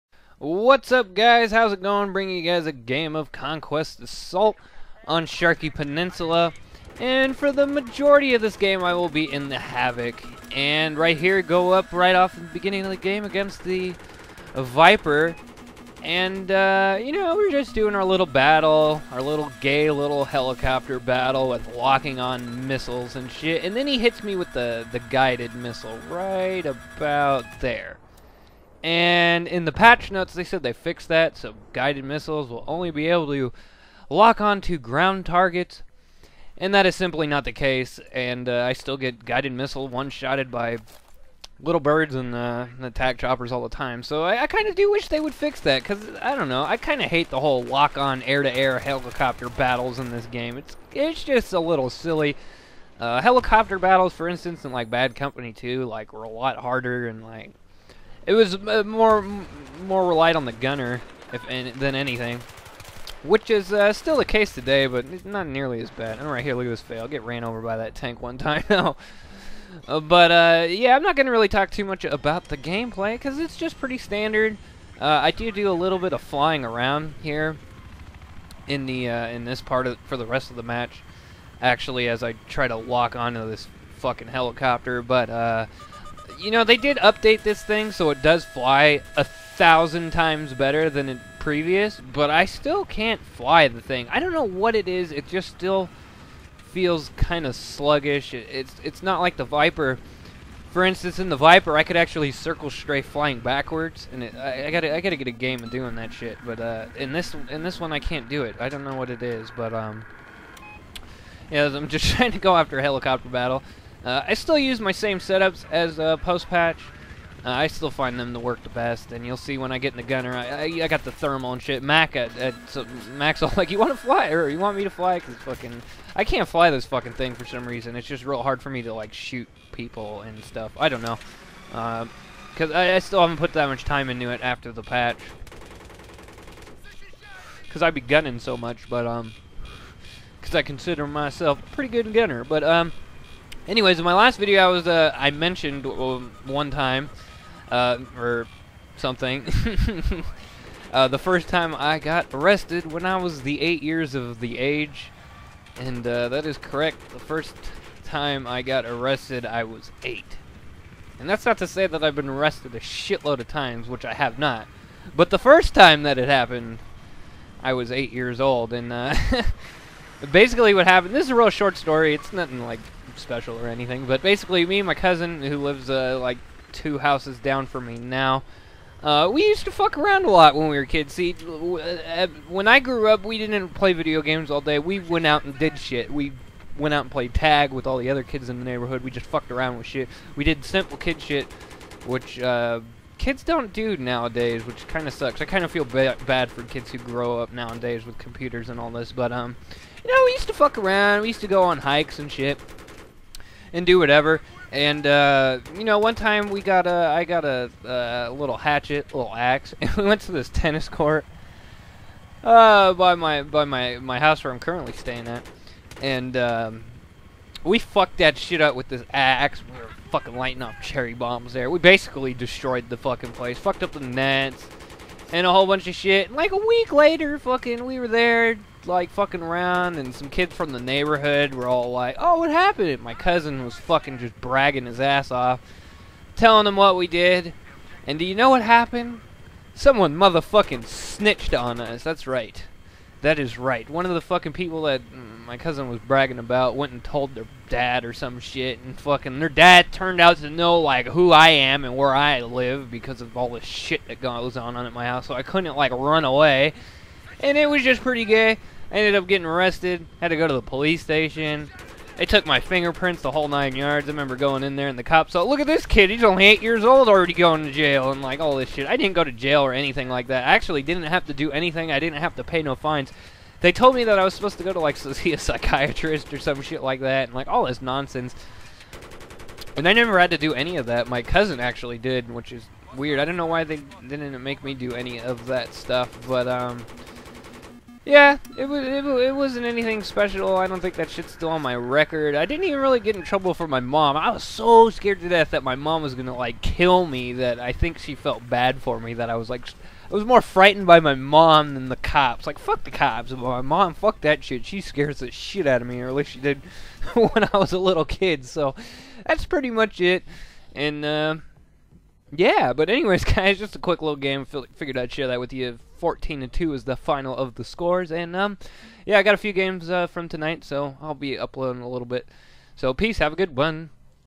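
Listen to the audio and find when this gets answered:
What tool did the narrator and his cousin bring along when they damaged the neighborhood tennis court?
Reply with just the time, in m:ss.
3:28.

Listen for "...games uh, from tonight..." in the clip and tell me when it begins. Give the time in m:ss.
5:19.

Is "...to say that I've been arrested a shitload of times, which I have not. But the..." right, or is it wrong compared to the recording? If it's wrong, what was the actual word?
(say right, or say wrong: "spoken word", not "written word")
right.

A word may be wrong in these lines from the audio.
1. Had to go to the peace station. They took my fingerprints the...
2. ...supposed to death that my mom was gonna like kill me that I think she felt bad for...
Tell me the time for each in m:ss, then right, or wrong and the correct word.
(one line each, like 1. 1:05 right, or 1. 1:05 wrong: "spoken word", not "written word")
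1. 4:20 wrong: "police", not "peace"
2. 4:54 wrong: "scared", not "supposed".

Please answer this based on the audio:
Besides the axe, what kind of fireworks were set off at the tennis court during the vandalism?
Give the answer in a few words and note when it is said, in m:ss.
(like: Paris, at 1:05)
cherry bombs, at 3:40.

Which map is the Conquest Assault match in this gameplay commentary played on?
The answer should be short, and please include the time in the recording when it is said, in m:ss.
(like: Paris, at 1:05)
Sharqi Peninsula, at 0:05.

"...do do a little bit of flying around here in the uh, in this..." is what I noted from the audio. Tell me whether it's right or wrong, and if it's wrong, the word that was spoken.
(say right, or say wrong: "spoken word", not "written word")
right.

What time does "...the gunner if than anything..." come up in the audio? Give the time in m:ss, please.
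1:00.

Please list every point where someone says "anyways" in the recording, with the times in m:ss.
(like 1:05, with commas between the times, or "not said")
2:23, 5:12.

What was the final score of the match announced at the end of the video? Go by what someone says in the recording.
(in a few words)
14 to 2.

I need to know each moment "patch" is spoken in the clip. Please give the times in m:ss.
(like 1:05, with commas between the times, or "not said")
0:29, 1:56, 2:14.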